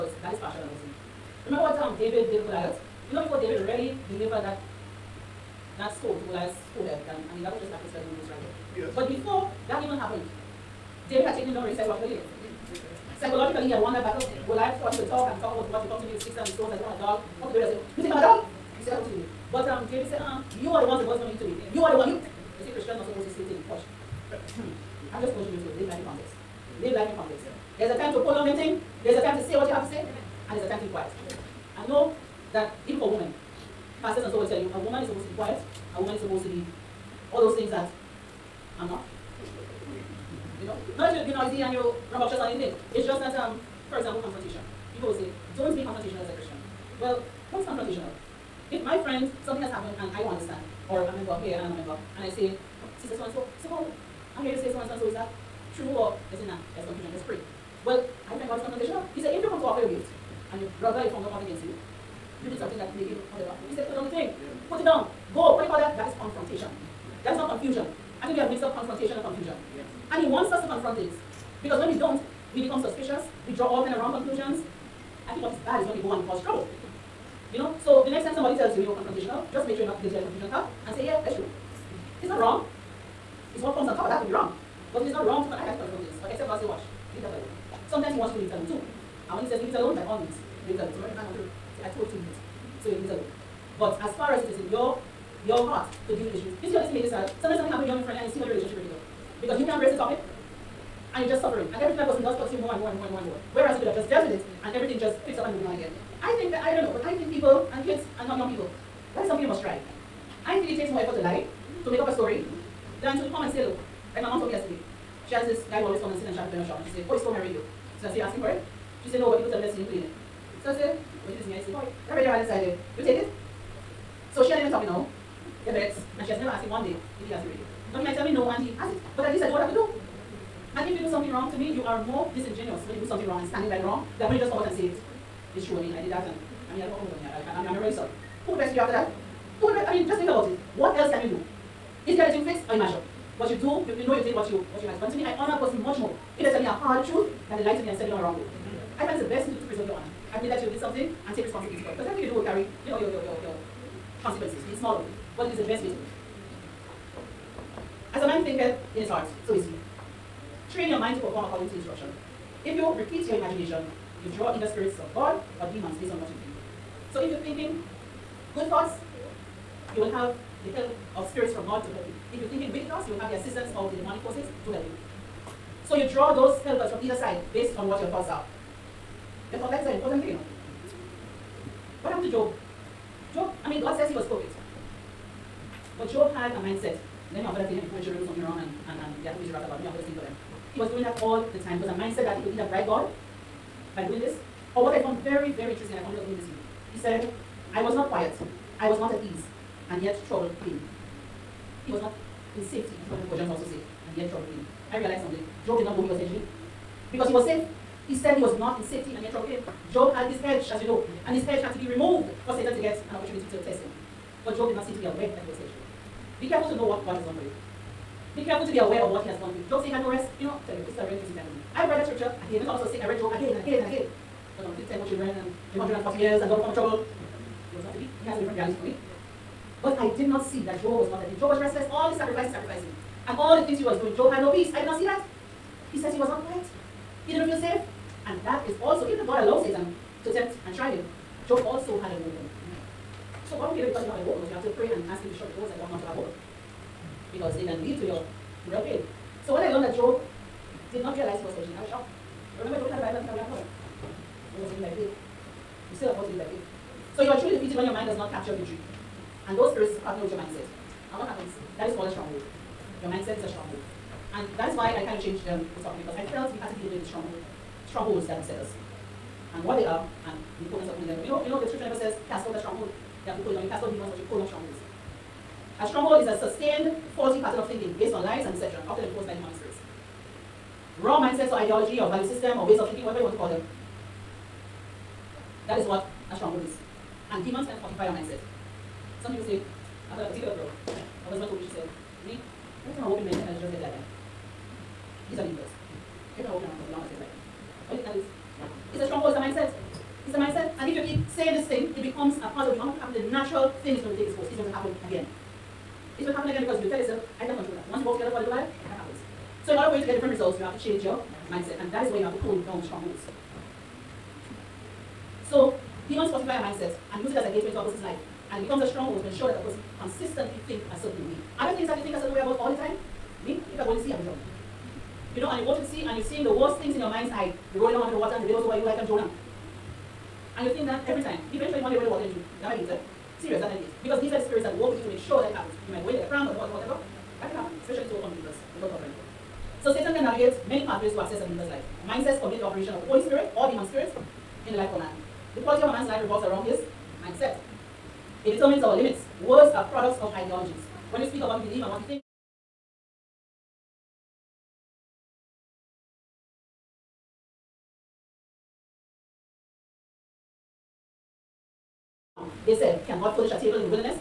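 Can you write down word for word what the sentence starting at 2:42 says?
If you repeat your imagination, you draw either spirits of God or demons based on what you think.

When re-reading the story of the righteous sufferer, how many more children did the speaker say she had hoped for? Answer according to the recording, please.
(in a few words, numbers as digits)
10.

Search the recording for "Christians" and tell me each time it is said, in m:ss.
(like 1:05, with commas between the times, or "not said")
0:22, 0:46.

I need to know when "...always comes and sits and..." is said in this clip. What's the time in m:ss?
1:55.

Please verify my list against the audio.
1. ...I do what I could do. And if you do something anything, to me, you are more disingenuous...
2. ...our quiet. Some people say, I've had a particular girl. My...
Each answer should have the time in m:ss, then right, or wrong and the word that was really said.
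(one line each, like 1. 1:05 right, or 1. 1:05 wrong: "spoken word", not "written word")
1. 2:09 wrong: "wrong", not "anything"
2. 4:48 wrong: "mindset", not "quiet".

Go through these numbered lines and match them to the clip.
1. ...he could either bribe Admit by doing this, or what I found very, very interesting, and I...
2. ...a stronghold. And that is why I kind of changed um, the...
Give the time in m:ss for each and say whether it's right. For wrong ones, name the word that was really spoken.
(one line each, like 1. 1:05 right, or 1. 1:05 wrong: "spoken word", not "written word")
1. 3:12 wrong: "God", not "Admit"
2. 4:23 right.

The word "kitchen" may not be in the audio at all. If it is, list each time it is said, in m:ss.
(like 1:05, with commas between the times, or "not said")
not said.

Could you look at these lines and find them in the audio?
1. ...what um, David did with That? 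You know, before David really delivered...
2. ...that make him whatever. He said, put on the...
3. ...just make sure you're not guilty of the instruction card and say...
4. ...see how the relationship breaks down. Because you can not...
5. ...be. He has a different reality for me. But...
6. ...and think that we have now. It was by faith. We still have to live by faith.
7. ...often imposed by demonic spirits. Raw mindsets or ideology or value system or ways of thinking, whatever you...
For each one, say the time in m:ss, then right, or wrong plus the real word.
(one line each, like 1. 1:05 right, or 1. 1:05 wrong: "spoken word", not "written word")
1. 0:01 wrong: "Goliath", not "That"
2. 1:02 right
3. 1:19 wrong: "confusion", not "instruction"
4. 1:38 right
5. 3:47 right
6. 4:13 right
7. 4:38 right.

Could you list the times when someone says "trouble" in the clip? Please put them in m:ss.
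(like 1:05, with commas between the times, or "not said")
1:16, 3:20, 3:24, 3:29, 3:46.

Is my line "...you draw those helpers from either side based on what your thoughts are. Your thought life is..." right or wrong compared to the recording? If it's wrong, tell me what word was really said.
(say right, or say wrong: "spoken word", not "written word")
right.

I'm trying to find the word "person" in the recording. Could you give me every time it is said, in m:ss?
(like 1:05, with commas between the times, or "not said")
1:42, 2:25.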